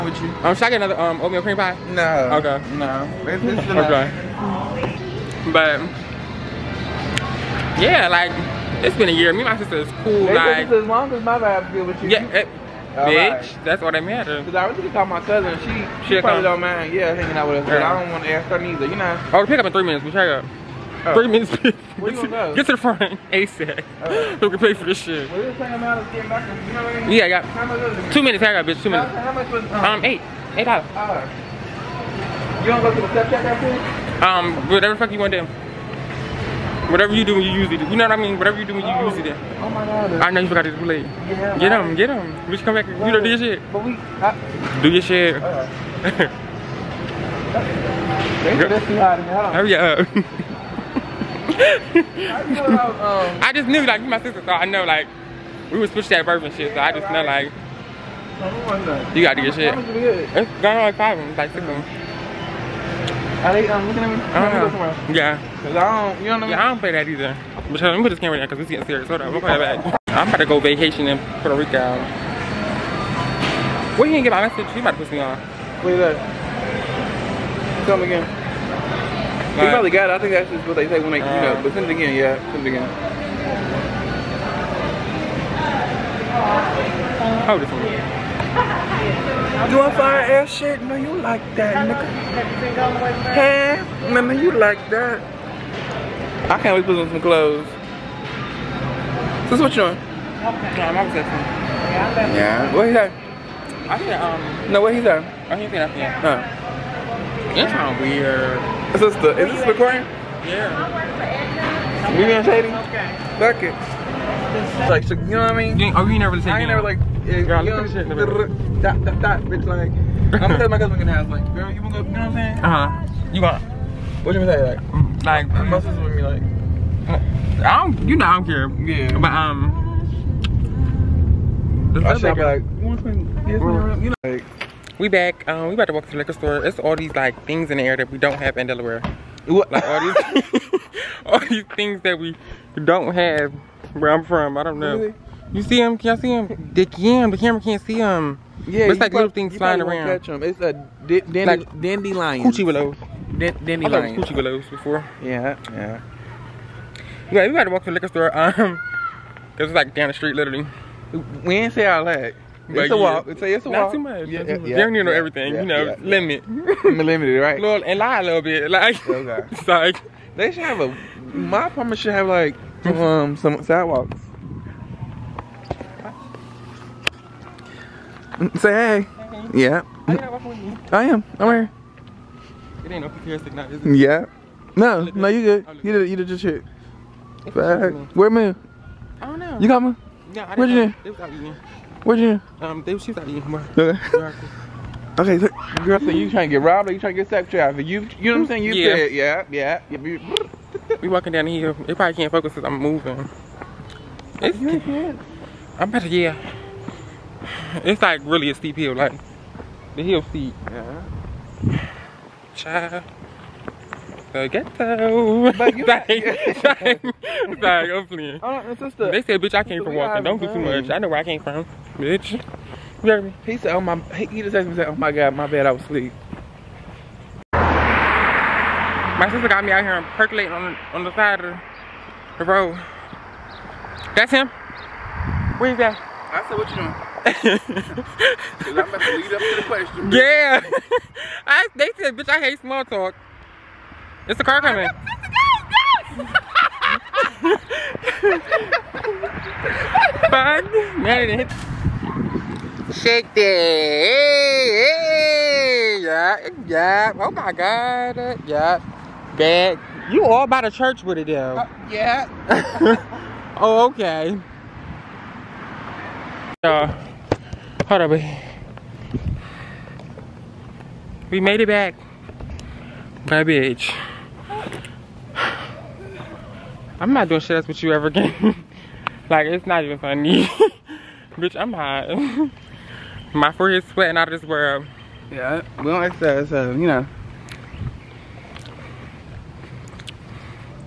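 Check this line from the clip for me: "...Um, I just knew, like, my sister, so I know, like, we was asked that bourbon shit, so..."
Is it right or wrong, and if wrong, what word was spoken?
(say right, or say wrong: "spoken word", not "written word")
wrong: "pushed", not "asked".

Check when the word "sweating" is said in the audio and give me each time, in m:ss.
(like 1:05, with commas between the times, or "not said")
4:43.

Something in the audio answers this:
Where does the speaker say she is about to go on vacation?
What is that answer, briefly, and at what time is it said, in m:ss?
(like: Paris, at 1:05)
Puerto Rico, at 1:11.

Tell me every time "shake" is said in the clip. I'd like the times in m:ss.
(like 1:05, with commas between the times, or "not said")
2:12, 4:12.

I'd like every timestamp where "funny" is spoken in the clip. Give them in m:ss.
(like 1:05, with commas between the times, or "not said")
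4:39.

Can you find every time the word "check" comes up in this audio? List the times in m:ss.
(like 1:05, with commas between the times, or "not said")
0:20, 0:33.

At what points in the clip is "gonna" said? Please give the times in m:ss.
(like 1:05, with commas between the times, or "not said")
0:14, 2:00, 2:04.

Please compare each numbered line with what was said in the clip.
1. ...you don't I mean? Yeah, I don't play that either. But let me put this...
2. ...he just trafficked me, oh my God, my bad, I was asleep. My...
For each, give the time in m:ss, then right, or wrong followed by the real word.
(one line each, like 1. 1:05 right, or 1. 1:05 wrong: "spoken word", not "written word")
1. 1:06 right
2. 3:44 wrong: "asked", not "trafficked".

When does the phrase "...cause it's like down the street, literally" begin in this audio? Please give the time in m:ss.
2:39.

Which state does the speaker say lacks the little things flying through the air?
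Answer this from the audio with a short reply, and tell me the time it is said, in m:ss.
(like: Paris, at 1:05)
Delaware, at 2:18.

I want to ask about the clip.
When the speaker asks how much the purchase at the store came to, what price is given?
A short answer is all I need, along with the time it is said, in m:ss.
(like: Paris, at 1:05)
8 dollars, at 0:30.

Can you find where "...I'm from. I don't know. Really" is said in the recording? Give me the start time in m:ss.
2:24.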